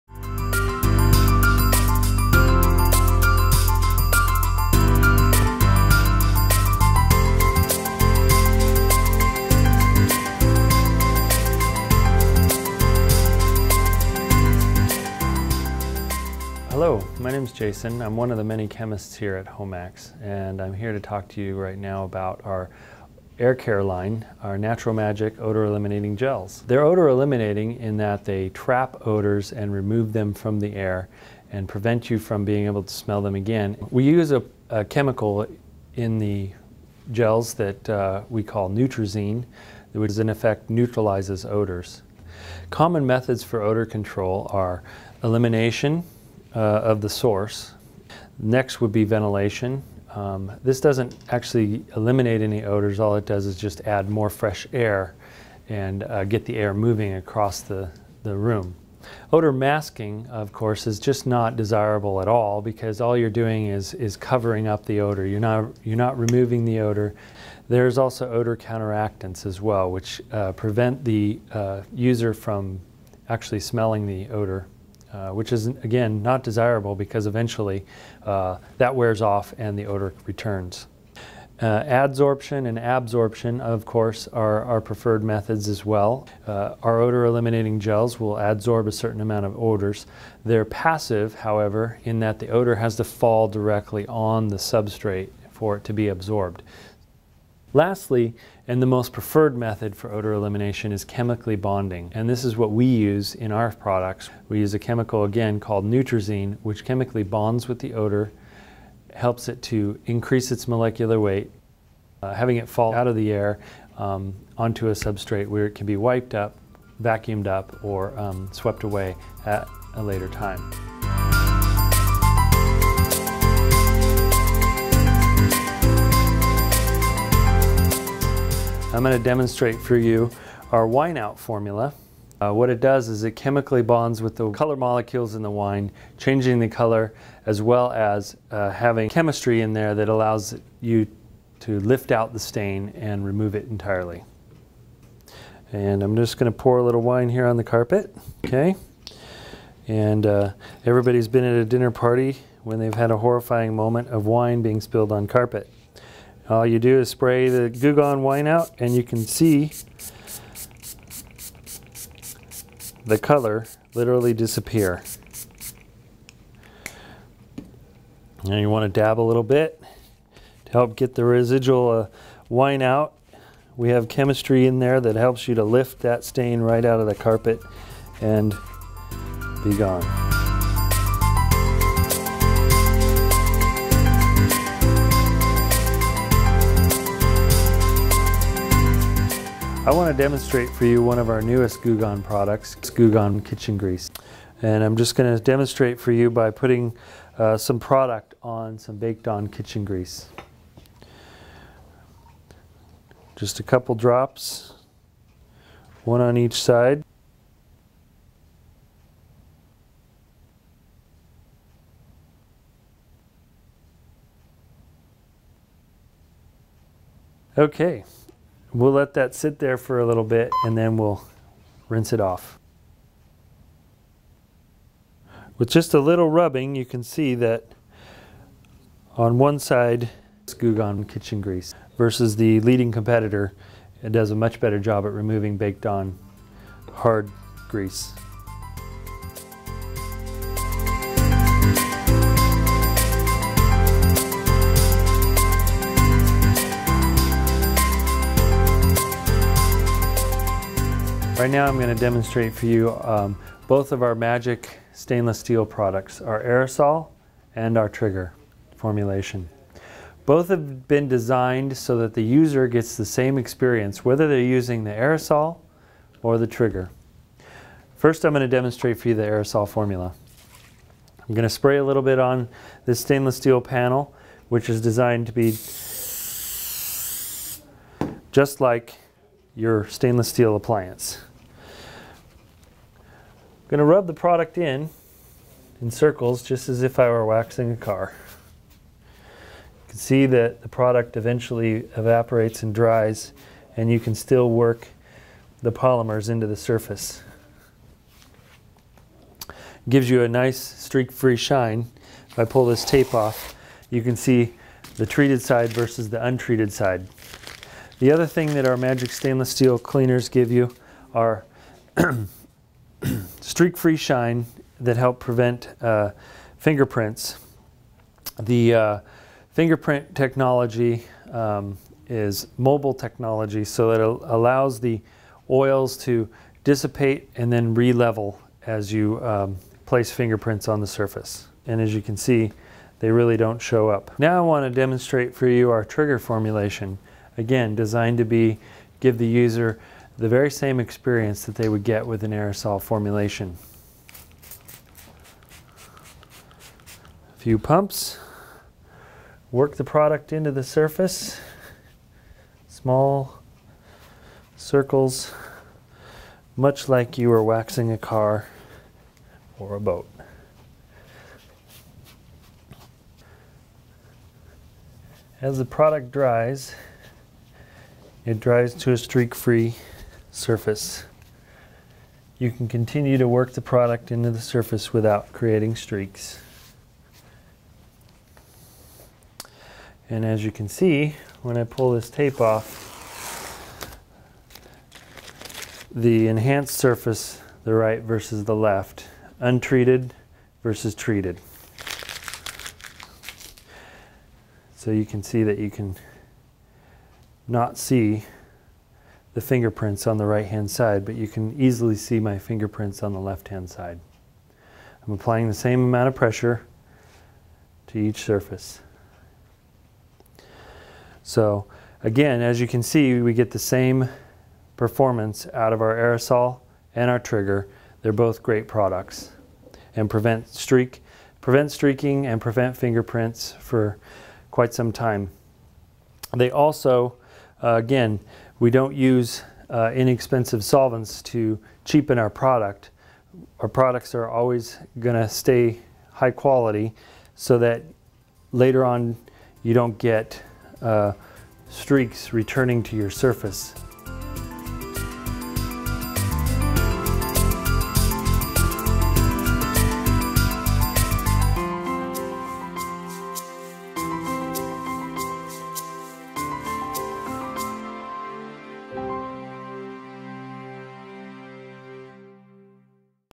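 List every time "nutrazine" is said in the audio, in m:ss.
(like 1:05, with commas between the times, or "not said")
0:38, 1:45.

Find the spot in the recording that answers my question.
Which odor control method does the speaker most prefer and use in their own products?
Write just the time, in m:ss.
1:41.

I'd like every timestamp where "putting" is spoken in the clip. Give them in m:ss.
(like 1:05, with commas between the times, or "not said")
3:16.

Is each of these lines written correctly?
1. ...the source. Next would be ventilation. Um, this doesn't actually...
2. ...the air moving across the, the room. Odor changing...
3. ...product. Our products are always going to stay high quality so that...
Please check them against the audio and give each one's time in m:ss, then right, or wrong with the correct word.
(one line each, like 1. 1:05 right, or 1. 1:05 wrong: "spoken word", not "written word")
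1. 0:47 right
2. 0:56 wrong: "masking", not "changing"
3. 7:12 right.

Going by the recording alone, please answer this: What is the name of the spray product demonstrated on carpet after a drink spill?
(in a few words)
Goo Gone Wine Out.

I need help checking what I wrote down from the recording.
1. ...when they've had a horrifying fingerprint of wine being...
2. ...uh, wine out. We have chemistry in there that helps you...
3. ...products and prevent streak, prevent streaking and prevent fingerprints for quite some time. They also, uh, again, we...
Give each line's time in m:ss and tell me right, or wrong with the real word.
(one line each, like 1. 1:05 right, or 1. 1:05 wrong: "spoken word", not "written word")
1. 2:32 wrong: "moment", not "fingerprint"
2. 2:51 right
3. 6:58 right.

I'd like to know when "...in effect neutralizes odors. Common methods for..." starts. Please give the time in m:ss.
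0:40.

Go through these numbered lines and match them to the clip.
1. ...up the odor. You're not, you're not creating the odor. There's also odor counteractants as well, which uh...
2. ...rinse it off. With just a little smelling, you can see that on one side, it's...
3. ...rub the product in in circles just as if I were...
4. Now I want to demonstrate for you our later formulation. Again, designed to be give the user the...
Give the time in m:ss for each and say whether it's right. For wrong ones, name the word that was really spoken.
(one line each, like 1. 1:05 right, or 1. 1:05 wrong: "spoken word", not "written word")
1. 1:04 wrong: "removing", not "creating"
2. 3:41 wrong: "rubbing", not "smelling"
3. 4:43 right
4. 5:34 wrong: "trigger", not "later".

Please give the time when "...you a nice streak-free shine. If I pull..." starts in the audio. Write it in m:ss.
5:00.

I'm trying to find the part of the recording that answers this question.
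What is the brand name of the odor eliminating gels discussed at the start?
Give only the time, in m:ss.
0:24.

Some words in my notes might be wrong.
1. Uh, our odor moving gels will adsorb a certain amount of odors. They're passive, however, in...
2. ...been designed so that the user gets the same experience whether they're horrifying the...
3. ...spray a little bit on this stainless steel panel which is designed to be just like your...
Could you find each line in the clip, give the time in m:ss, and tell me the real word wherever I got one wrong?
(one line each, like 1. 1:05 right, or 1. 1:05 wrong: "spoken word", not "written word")
1. 1:26 wrong: "eliminating", not "moving"
2. 4:20 wrong: "using", not "horrifying"
3. 4:31 right.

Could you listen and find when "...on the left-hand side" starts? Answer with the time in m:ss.
6:43.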